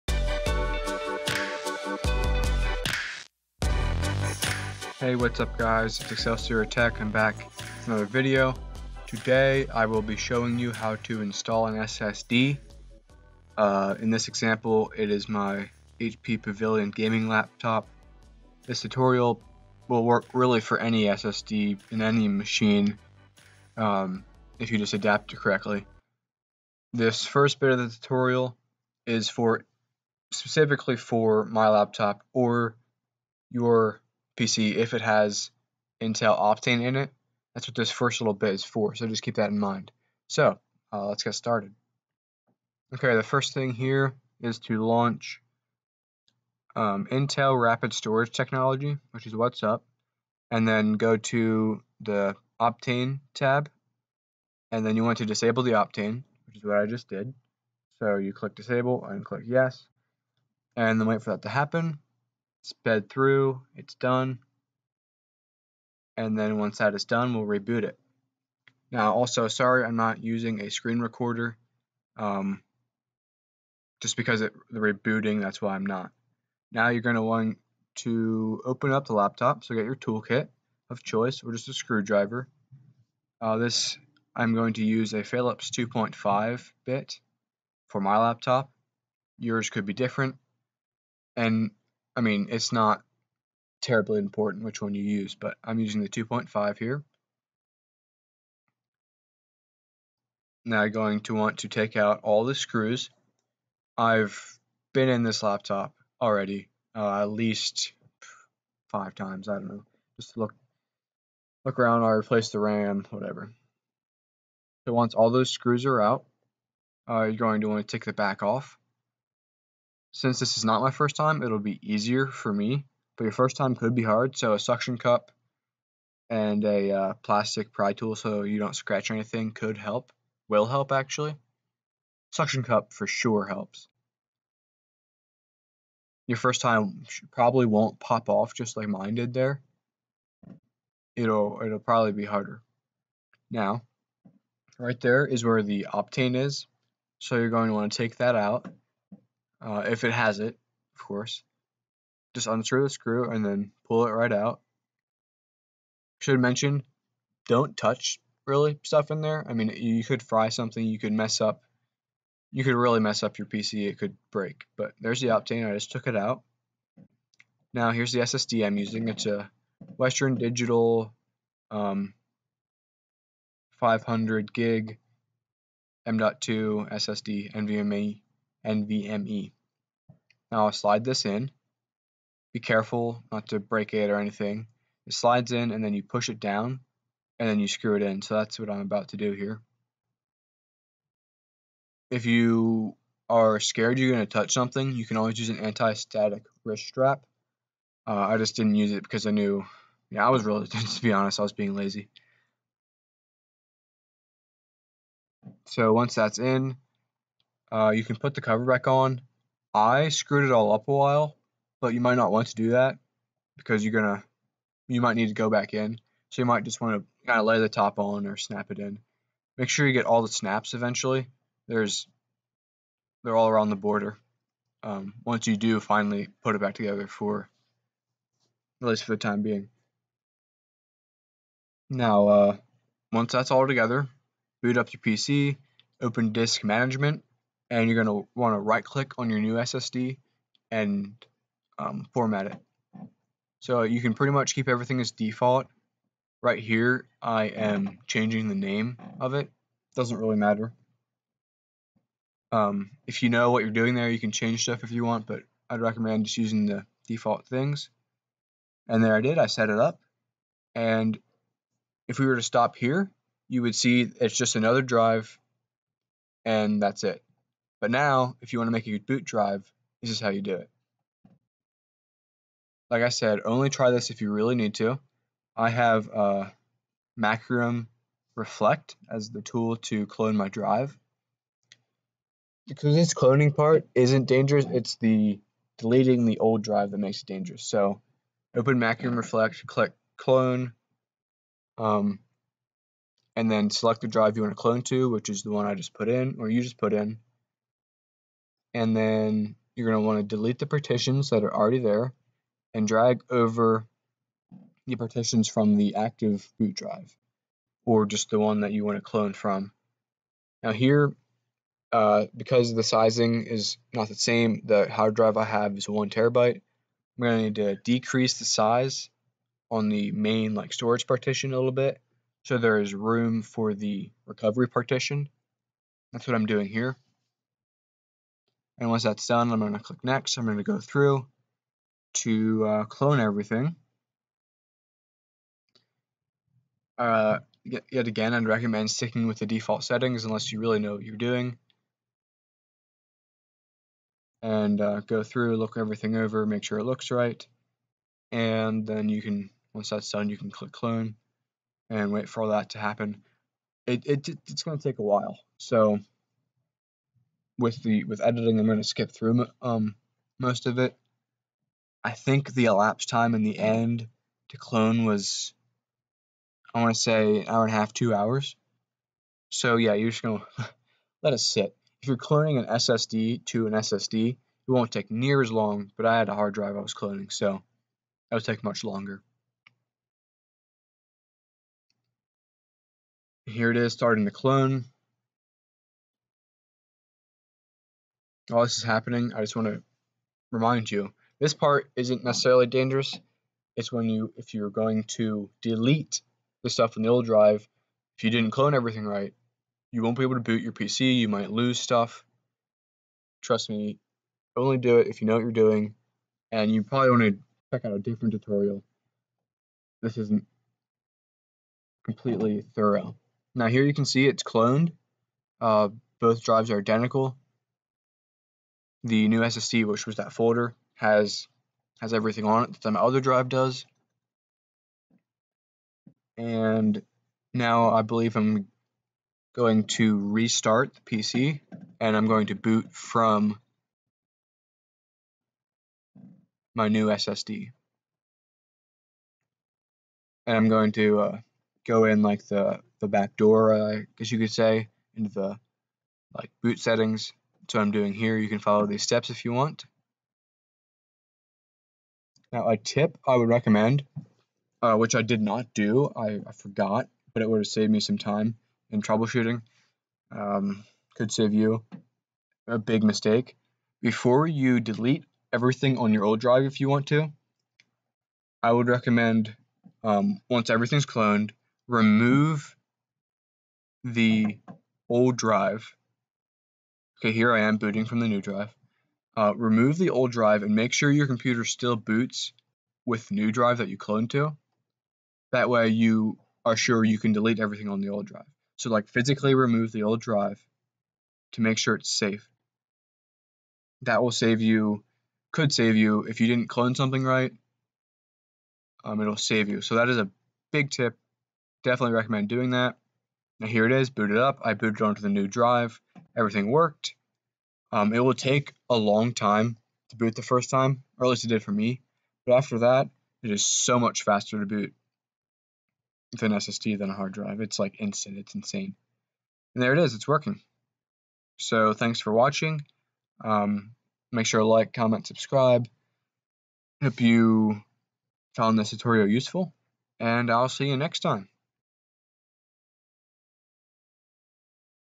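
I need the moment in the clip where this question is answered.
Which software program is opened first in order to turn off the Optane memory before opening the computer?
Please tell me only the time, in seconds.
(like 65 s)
47 s.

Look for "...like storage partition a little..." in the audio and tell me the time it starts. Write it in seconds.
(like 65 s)
320 s.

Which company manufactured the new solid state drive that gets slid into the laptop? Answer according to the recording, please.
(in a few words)
Western Digital.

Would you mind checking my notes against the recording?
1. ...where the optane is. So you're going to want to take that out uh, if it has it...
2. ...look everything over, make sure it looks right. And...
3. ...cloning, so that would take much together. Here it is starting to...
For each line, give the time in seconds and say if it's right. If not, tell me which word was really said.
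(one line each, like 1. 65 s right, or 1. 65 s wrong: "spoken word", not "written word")
1. 145 s right
2. 345 s right
3. 376 s wrong: "longer", not "together".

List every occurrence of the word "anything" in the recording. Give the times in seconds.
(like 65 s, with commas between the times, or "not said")
129 s, 184 s.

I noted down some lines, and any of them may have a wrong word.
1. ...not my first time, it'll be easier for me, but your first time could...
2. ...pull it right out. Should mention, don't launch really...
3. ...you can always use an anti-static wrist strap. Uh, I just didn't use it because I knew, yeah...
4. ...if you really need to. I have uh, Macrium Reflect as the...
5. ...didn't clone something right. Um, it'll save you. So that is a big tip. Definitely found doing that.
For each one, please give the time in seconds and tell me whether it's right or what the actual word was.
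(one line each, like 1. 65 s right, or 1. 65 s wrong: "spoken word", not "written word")
1. 120 s right
2. 153 s wrong: "touch", not "launch"
3. 194 s right
4. 274 s right
5. 496 s wrong: "recommend", not "found".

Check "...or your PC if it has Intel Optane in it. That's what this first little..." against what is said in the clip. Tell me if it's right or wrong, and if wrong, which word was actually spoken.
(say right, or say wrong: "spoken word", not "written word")
right.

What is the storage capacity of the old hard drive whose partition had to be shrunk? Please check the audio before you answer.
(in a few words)
1 terabyte.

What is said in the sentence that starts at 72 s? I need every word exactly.
Um, just because it, the rebooting, that's why I'm not.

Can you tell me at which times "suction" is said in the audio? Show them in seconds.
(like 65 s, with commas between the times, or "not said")
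124 s, 132 s.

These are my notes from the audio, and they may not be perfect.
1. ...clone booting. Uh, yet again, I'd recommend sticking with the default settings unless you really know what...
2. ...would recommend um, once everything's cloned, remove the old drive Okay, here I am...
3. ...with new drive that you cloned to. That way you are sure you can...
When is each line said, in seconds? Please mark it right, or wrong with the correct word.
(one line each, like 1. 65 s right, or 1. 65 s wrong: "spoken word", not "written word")
1. 332 s wrong: "everything", not "booting"
2. 468 s right
3. 483 s right.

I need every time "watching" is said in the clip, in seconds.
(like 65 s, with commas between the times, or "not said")
522 s.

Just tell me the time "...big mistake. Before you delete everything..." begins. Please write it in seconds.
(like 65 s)
462 s.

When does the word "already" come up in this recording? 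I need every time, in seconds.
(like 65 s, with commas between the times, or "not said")
106 s, 301 s.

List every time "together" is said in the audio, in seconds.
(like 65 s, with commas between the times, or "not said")
226 s, 233 s.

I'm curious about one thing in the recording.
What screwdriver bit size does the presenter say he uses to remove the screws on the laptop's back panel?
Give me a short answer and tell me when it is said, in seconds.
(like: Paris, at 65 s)
Phillips 2.5, at 85 s.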